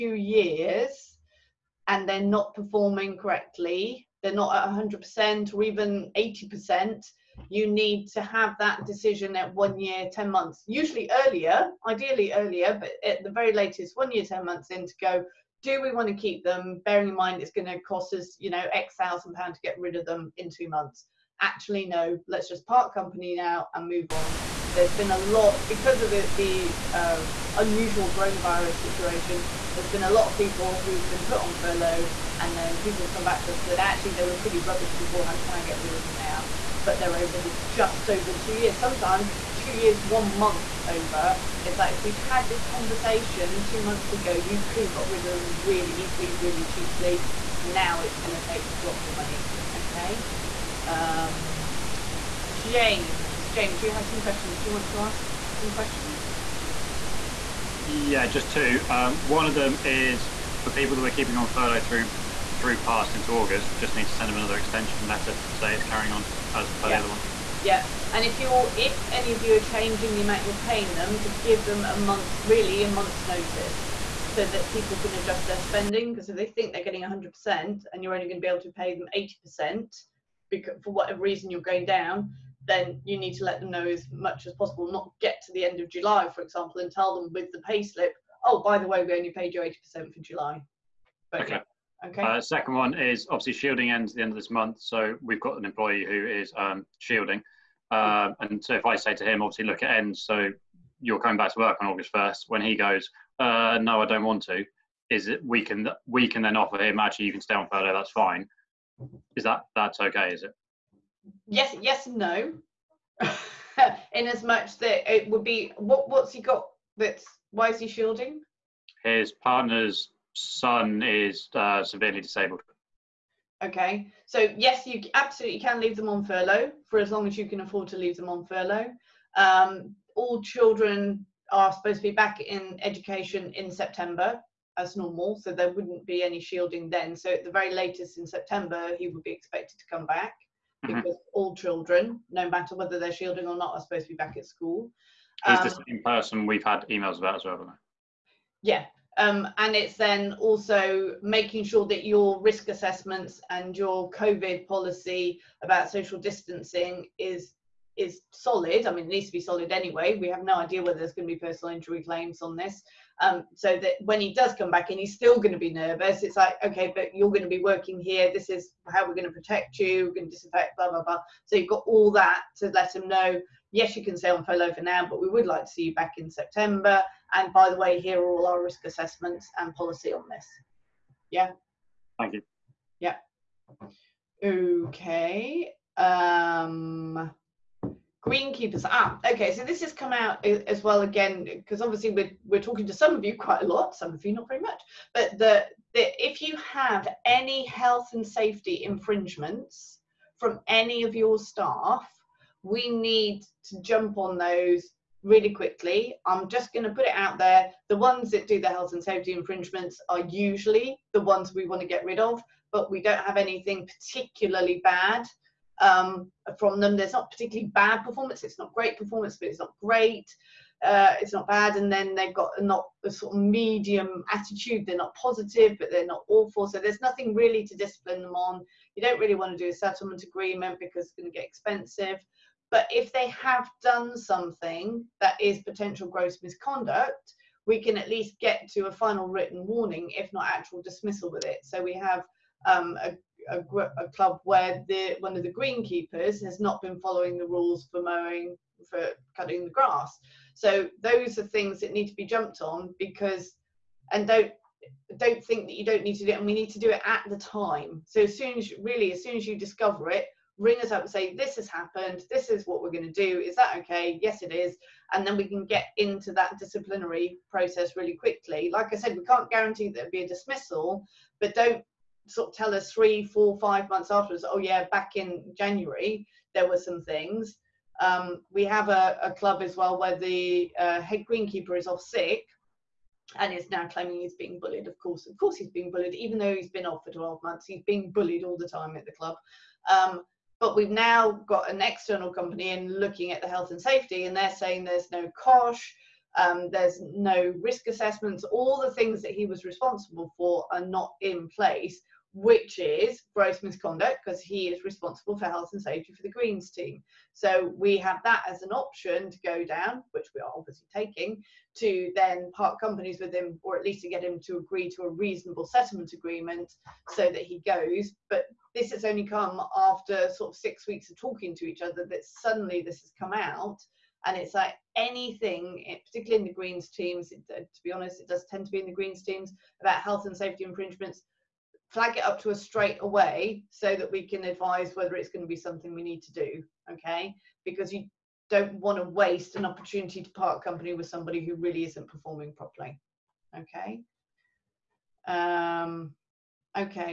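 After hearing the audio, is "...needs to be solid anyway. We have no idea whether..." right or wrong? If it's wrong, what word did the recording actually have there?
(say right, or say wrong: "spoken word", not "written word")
right.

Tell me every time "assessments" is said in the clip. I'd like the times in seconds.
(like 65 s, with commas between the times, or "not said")
152 s, 178 s, 297 s.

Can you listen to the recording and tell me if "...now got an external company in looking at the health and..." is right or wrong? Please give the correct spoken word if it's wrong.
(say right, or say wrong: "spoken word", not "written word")
right.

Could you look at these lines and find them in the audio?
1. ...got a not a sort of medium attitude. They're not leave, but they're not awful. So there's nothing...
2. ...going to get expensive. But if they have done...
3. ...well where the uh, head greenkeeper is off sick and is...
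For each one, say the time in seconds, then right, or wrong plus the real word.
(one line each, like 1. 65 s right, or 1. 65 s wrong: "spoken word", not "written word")
1. 222 s wrong: "positive", not "leave"
2. 231 s right
3. 279 s right.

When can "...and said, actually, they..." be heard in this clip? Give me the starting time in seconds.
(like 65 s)
33 s.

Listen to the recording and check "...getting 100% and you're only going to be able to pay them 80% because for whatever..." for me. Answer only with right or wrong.
right.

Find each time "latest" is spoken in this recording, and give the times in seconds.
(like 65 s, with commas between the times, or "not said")
13 s, 137 s.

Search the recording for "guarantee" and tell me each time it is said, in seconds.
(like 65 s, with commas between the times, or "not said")
269 s.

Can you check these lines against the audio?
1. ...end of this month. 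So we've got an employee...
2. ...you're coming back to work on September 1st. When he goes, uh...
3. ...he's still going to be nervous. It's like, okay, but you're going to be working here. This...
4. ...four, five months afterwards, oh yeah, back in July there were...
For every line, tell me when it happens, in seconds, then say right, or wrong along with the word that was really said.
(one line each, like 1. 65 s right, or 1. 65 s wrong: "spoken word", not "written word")
1. 94 s right
2. 101 s wrong: "August", not "September"
3. 164 s right
4. 273 s wrong: "January", not "July".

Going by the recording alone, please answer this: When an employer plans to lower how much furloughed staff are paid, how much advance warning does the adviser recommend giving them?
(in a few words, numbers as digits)
a month's notice.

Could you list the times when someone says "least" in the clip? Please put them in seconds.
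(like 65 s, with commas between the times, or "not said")
238 s, 313 s.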